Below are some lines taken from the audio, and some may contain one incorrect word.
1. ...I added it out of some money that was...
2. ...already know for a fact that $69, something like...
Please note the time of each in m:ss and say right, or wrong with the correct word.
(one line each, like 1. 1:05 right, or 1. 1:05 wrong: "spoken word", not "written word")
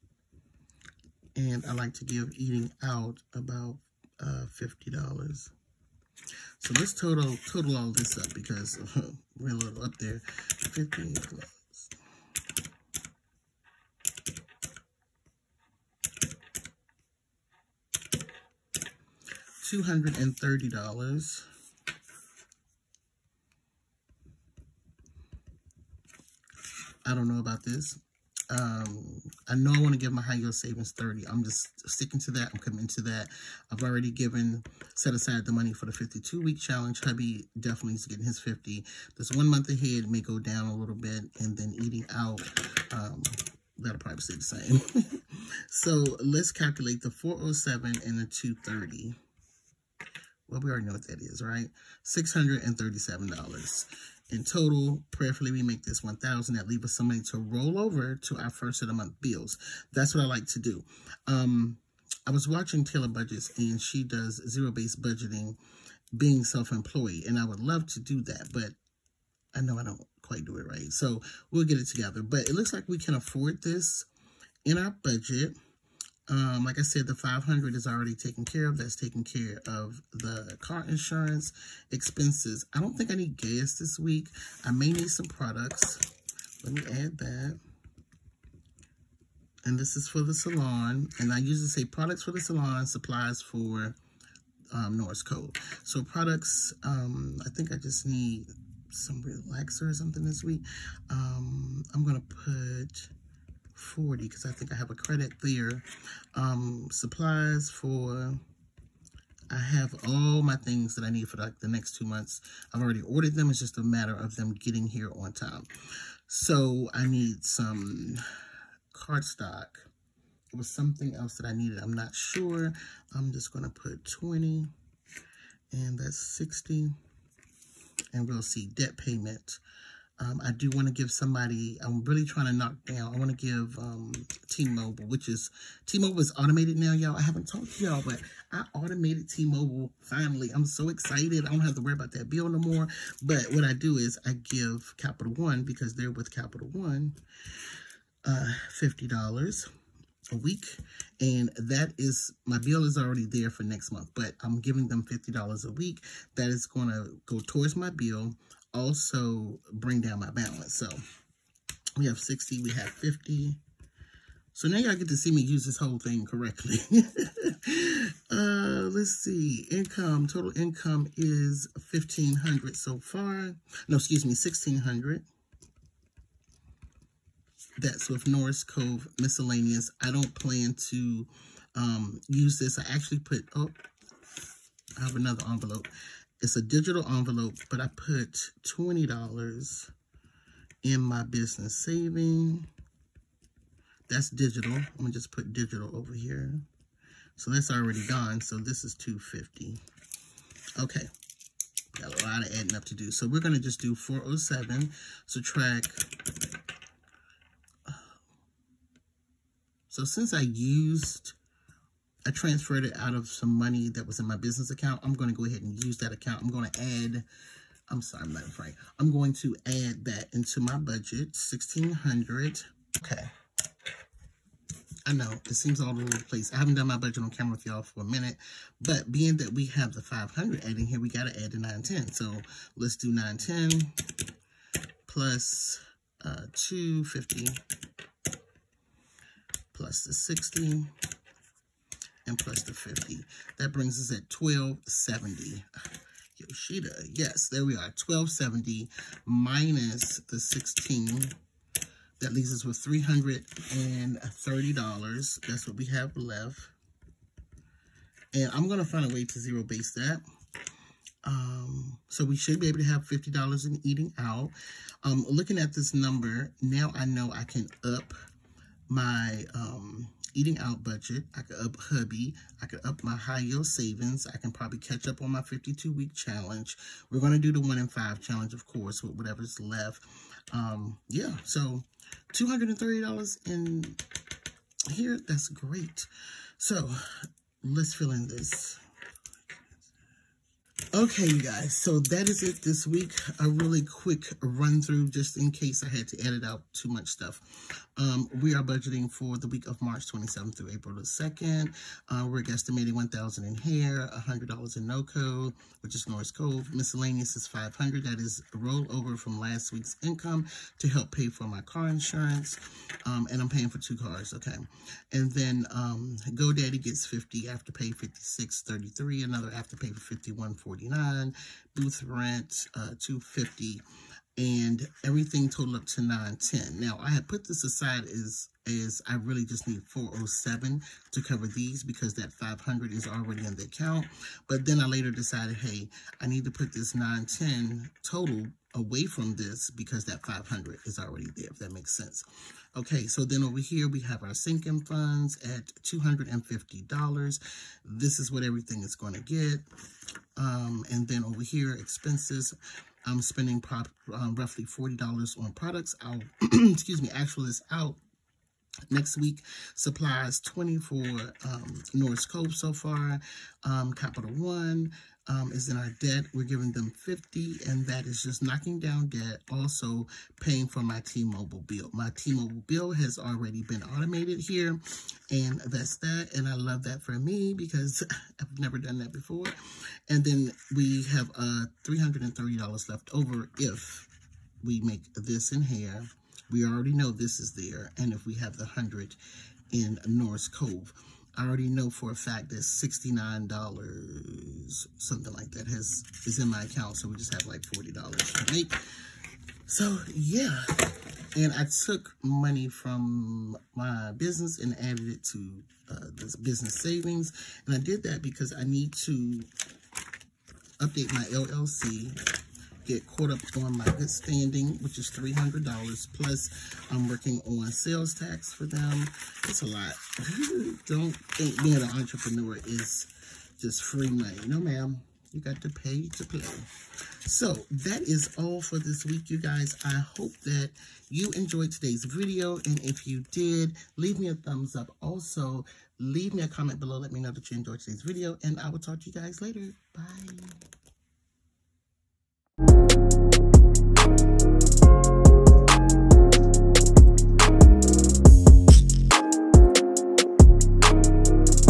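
1. 3:32 wrong: "transferred", not "added"
2. 6:31 right.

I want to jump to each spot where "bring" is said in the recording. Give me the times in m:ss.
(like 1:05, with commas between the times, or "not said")
2:39, 4:03.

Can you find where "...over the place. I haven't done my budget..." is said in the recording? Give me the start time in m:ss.
3:45.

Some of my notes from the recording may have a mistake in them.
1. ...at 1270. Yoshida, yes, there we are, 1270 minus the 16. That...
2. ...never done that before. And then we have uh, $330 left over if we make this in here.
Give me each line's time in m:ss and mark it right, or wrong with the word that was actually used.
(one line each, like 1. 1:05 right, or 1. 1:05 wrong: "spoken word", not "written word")
1. 4:04 right
2. 6:18 right.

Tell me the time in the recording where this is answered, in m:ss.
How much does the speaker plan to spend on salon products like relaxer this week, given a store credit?
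1:41.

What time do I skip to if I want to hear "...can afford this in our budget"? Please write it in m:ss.
1:12.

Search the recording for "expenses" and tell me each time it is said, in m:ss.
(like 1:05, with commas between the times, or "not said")
1:21, 5:51.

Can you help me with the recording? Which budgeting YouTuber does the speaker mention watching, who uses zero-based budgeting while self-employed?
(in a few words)
Taylor Budgets.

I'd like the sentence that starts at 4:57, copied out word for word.
Um, we are budgeting for the week of March 27th through April the 2nd.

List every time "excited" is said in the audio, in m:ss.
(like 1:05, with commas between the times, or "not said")
2:20.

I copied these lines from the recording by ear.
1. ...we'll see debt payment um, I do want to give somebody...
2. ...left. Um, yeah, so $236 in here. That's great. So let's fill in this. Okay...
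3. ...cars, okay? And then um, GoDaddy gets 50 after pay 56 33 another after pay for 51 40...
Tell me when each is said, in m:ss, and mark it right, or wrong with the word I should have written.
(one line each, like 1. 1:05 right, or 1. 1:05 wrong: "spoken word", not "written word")
1. 2:08 right
2. 4:39 wrong: "230", not "236"
3. 5:13 right.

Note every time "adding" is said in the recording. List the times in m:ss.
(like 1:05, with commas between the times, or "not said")
3:22, 3:50.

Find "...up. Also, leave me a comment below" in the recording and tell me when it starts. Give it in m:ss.
7:14.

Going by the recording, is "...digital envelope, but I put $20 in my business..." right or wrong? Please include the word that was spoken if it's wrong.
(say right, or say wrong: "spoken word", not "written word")
right.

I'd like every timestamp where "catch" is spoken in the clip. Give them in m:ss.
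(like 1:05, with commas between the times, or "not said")
4:34.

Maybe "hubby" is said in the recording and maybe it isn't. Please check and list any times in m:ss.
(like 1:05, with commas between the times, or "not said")
0:37, 4:31.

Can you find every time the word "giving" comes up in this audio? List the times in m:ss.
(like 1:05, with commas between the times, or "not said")
2:34, 6:06.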